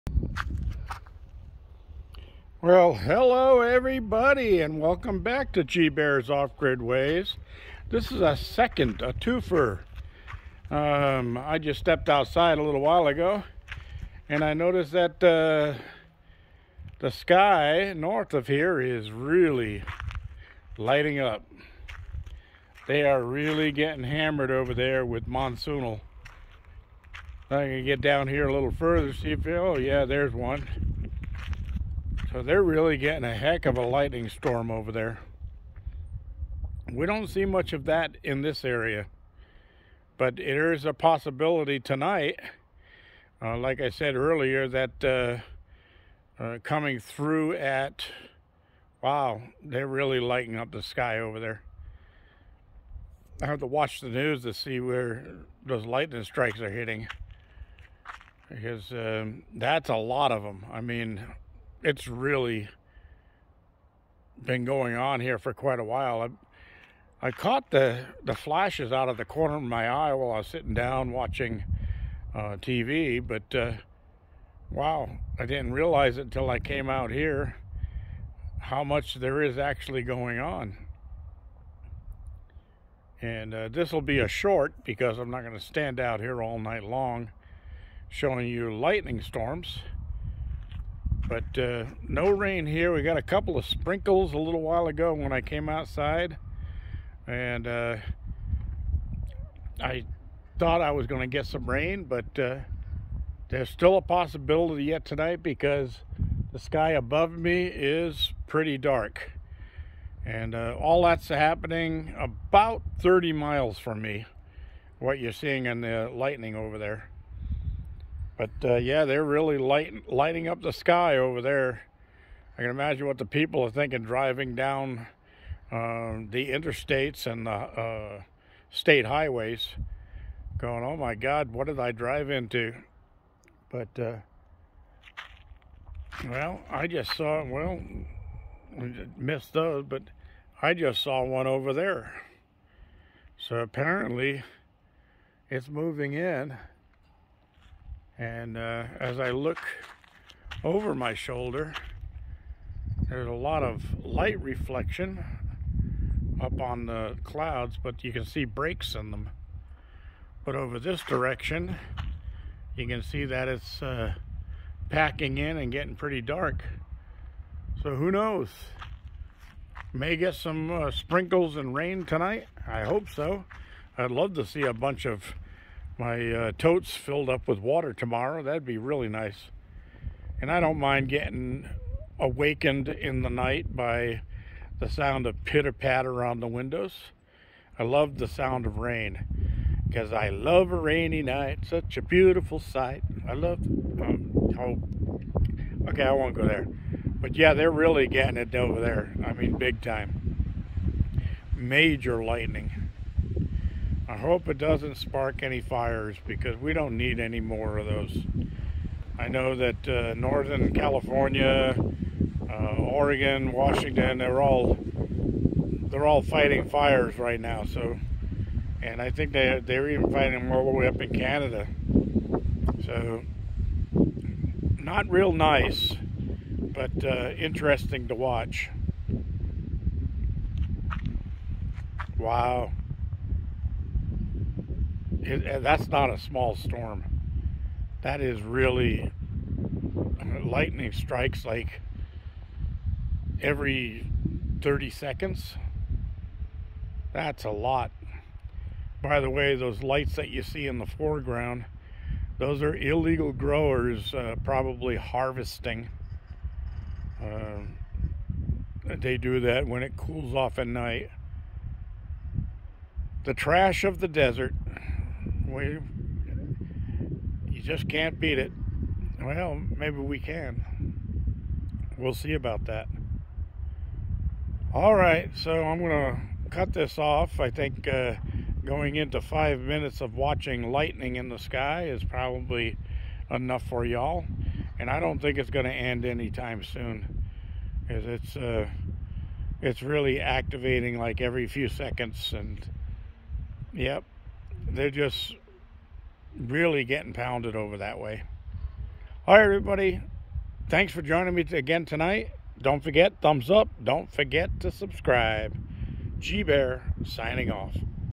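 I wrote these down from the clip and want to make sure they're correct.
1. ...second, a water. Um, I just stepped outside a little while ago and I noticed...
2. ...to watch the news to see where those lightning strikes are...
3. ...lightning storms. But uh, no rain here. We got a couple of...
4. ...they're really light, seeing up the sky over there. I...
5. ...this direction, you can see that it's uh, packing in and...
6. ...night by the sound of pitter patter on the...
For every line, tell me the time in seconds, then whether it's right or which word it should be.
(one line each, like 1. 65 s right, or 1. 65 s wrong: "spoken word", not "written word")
1. 8 s wrong: "twofer", not "water"
2. 53 s right
3. 88 s right
4. 119 s wrong: "lighting", not "seeing"
5. 160 s right
6. 183 s right.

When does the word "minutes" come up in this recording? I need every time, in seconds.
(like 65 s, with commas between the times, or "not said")
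279 s.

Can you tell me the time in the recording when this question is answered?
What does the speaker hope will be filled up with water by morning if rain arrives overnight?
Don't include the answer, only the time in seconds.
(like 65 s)
176 s.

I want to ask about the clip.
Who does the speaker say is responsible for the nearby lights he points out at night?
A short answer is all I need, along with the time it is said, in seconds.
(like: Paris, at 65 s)
illegal growers, at 252 s.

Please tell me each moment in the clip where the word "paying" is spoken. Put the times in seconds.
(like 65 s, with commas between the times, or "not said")
not said.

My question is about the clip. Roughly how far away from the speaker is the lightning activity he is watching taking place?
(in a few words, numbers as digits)
30 miles.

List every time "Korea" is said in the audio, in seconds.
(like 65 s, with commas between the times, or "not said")
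not said.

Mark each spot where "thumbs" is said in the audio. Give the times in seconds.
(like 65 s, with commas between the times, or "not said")
303 s.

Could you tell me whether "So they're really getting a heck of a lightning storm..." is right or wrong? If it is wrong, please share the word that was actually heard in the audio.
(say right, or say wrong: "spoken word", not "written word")
right.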